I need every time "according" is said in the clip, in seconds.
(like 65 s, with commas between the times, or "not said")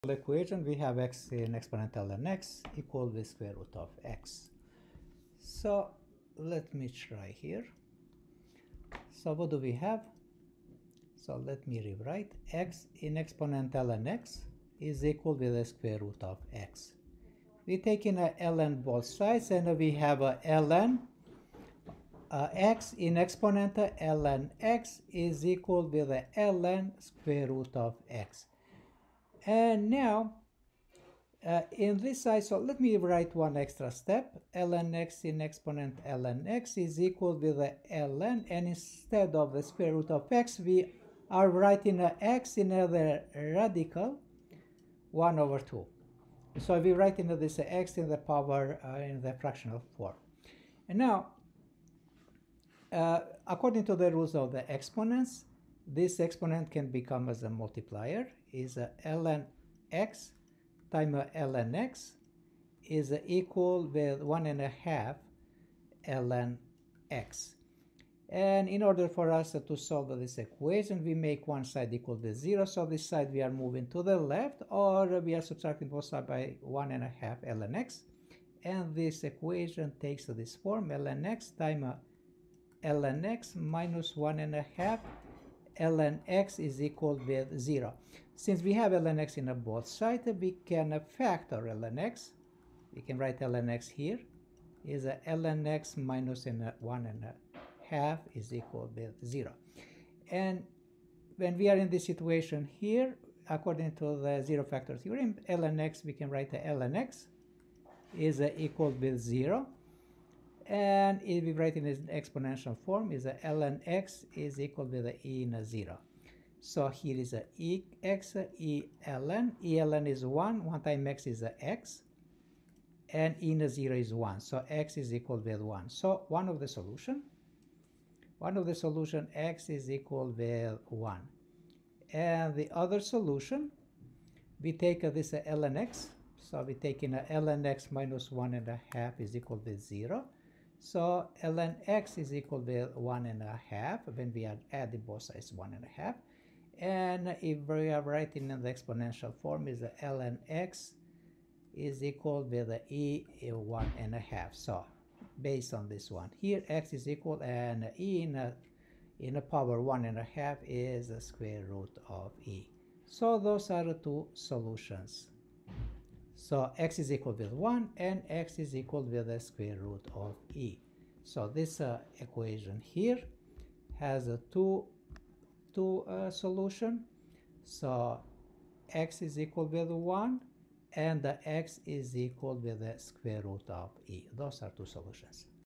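53 s, 103 s.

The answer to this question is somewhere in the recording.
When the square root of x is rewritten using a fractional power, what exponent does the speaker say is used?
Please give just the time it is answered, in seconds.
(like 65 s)
45 s.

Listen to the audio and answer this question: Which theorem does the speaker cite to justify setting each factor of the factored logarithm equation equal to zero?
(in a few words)
zero factor theorem.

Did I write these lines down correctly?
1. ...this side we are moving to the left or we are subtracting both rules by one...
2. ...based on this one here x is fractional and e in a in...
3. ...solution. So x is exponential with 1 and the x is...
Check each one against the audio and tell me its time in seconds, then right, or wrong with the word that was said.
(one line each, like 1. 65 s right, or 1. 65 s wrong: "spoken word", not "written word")
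1. 72 s wrong: "sides", not "rules"
2. 155 s wrong: "equal", not "fractional"
3. 176 s wrong: "equal", not "exponential".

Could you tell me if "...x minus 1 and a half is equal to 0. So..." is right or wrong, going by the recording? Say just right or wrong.
right.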